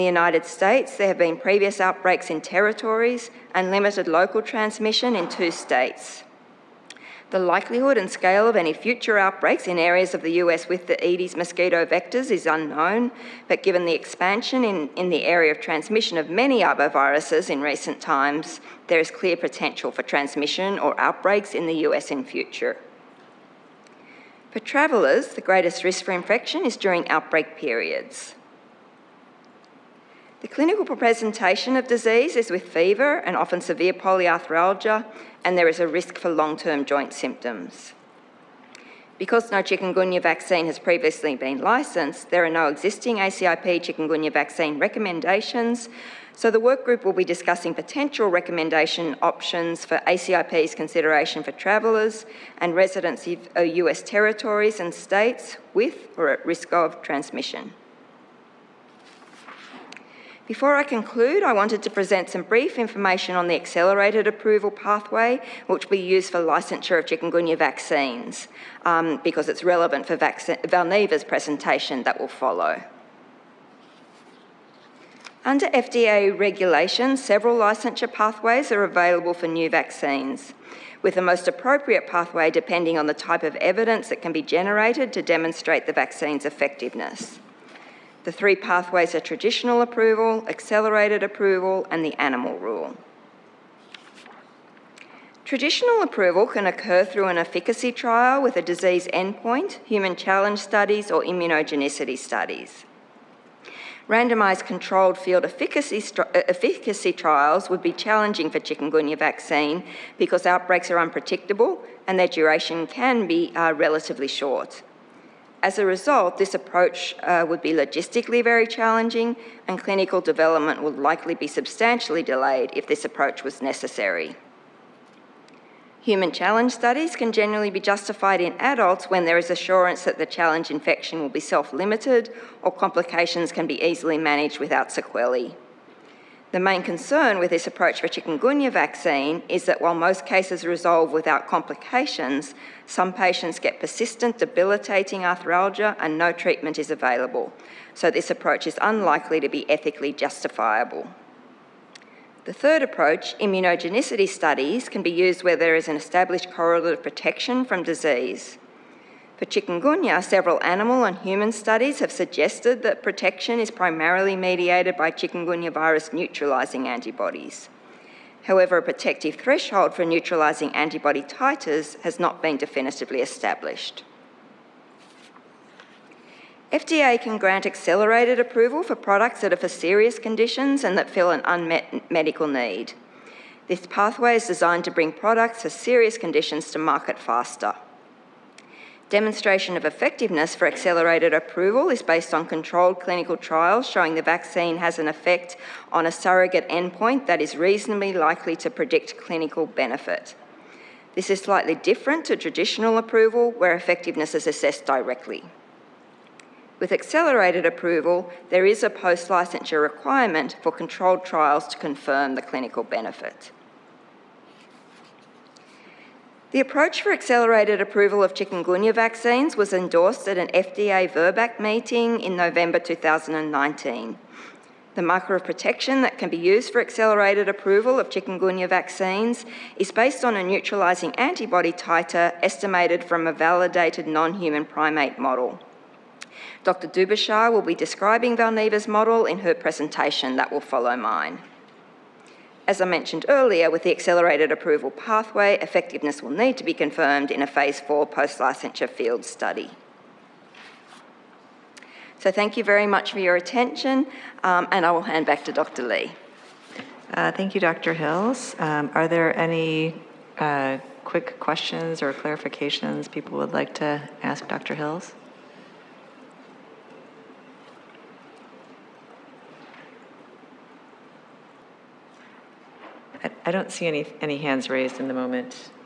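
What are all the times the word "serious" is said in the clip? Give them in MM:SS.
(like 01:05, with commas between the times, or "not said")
02:59, 03:05.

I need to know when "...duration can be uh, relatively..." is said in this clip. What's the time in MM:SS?
01:52.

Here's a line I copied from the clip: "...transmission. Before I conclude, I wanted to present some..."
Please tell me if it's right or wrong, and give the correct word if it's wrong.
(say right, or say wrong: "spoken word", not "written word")
right.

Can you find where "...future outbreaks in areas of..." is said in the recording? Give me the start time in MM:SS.
00:08.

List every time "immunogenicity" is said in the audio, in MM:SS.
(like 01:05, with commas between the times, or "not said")
01:41, 02:33.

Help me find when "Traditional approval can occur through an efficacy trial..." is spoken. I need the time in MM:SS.
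01:35.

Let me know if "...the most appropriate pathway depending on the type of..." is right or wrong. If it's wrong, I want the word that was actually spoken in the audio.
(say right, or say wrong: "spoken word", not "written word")
right.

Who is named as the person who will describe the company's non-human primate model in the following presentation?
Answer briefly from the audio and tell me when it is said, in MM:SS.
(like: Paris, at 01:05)
Dr. Dubischar, at 03:56.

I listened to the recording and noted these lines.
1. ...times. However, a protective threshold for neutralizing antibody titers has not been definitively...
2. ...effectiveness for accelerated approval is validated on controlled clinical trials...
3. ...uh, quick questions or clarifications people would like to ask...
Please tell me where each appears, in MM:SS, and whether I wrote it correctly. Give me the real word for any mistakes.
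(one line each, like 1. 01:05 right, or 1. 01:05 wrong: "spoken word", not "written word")
1. 02:46 wrong: "antibodies", not "times"
2. 03:09 wrong: "based", not "validated"
3. 04:20 right.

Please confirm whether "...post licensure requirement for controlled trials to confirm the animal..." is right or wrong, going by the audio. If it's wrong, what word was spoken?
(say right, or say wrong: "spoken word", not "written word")
wrong: "clinical", not "animal".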